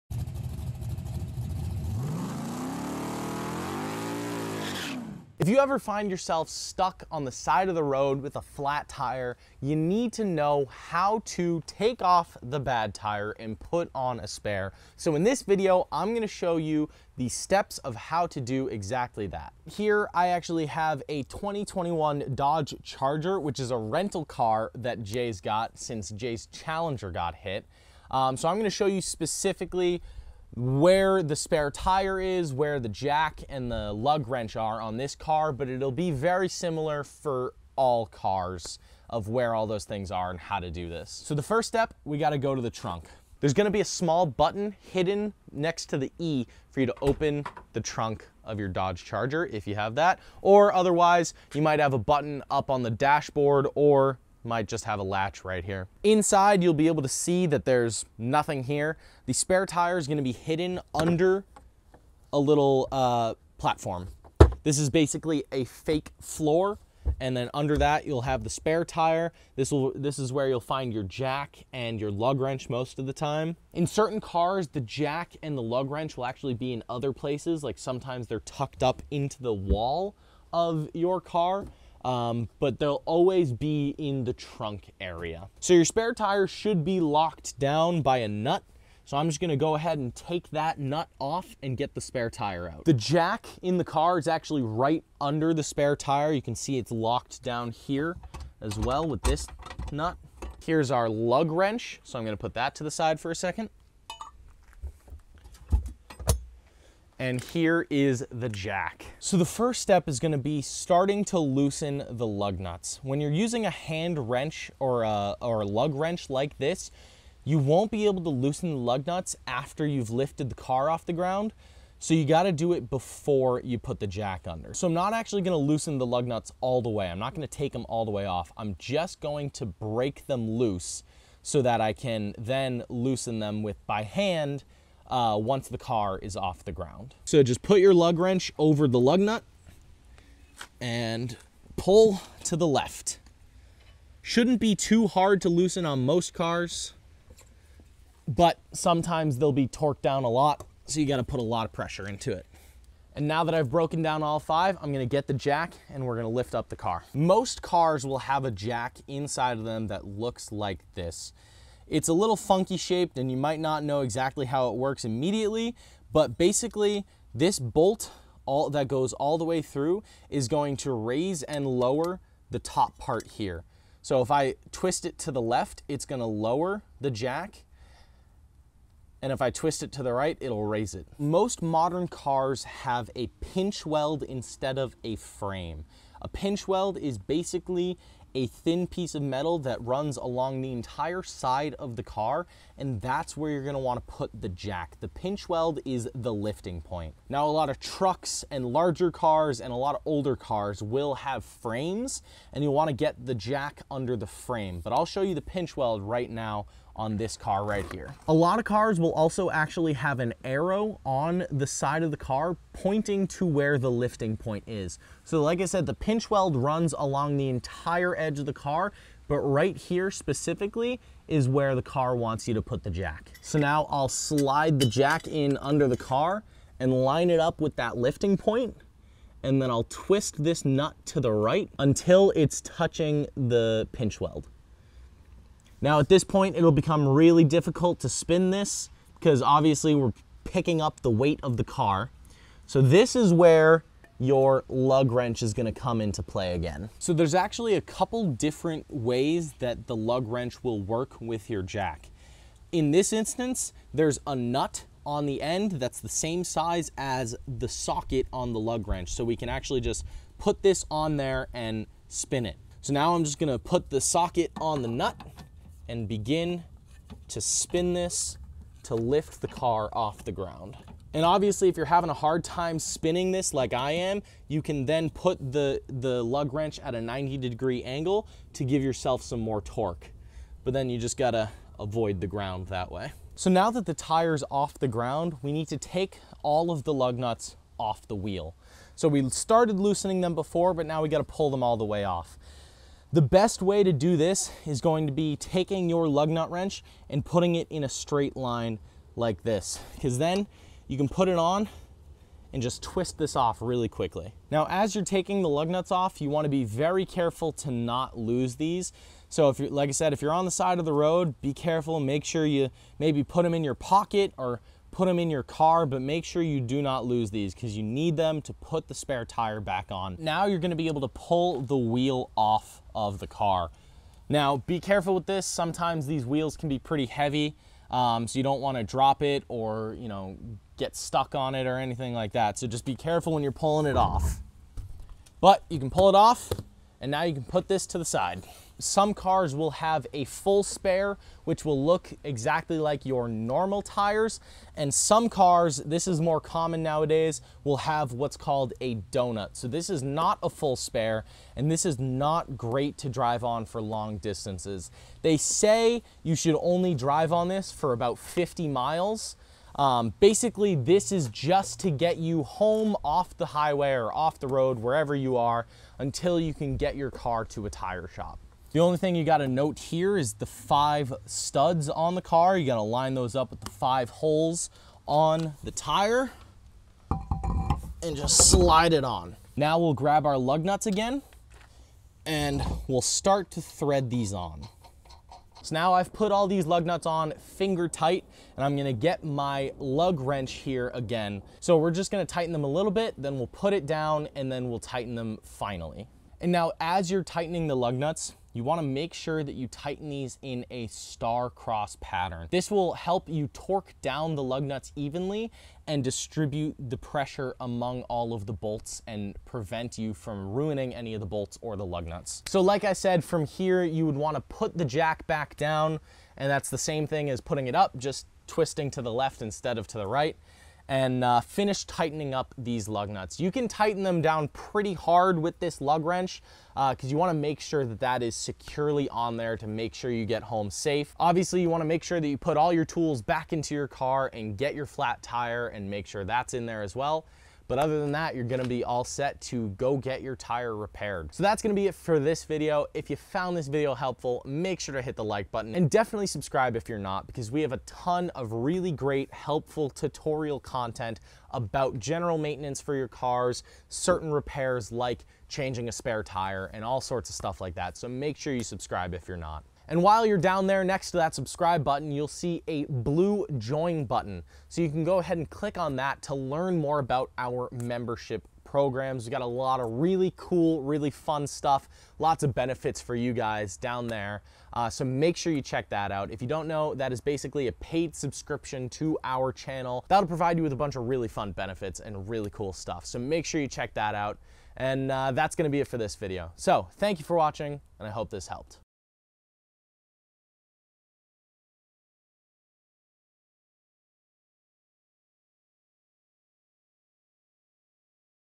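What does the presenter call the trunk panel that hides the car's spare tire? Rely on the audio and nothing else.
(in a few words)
fake floor.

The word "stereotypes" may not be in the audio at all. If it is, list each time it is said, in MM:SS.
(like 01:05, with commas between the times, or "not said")
not said.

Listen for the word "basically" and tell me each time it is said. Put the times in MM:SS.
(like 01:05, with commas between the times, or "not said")
01:04, 02:46, 03:07, 06:00, 07:57.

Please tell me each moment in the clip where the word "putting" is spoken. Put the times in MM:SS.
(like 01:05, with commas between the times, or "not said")
04:57, 06:57.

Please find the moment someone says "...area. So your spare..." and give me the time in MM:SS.
01:24.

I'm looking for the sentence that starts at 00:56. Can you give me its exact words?
Inside, you'll be able to see that there's nothing here.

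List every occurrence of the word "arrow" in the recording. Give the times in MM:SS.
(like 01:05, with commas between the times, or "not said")
03:30.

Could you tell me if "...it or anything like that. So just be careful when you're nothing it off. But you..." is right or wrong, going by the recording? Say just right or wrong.
wrong.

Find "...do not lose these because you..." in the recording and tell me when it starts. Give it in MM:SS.
05:16.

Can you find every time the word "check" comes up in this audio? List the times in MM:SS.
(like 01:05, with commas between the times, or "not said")
07:55, 08:03.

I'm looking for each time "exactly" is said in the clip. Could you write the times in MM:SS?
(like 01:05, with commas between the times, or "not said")
00:18, 02:43, 05:42.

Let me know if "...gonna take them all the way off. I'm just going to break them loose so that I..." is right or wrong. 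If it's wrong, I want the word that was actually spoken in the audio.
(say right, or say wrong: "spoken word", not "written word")
right.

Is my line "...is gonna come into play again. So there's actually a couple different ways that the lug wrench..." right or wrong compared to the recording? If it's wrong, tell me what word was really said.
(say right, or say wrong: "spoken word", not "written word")
right.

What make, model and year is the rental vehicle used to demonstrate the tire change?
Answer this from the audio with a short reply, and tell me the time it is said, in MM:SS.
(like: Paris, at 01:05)
2021 Dodge Charger, at 00:21.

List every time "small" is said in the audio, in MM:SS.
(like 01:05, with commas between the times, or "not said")
00:43.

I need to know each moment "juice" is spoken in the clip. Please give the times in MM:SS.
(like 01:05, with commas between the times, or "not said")
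not said.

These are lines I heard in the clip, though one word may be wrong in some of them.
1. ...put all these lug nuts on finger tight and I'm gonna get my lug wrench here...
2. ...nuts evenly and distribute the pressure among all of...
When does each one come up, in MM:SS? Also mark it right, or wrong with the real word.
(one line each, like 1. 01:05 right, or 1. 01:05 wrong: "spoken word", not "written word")
1. 06:26 right
2. 06:44 right.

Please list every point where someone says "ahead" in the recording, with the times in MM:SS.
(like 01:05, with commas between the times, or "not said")
01:29, 07:45.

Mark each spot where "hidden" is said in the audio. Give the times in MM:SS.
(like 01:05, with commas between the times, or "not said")
00:44, 01:00.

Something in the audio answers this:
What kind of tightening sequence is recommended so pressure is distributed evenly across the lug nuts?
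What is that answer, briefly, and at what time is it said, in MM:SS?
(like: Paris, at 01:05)
star cross pattern, at 06:40.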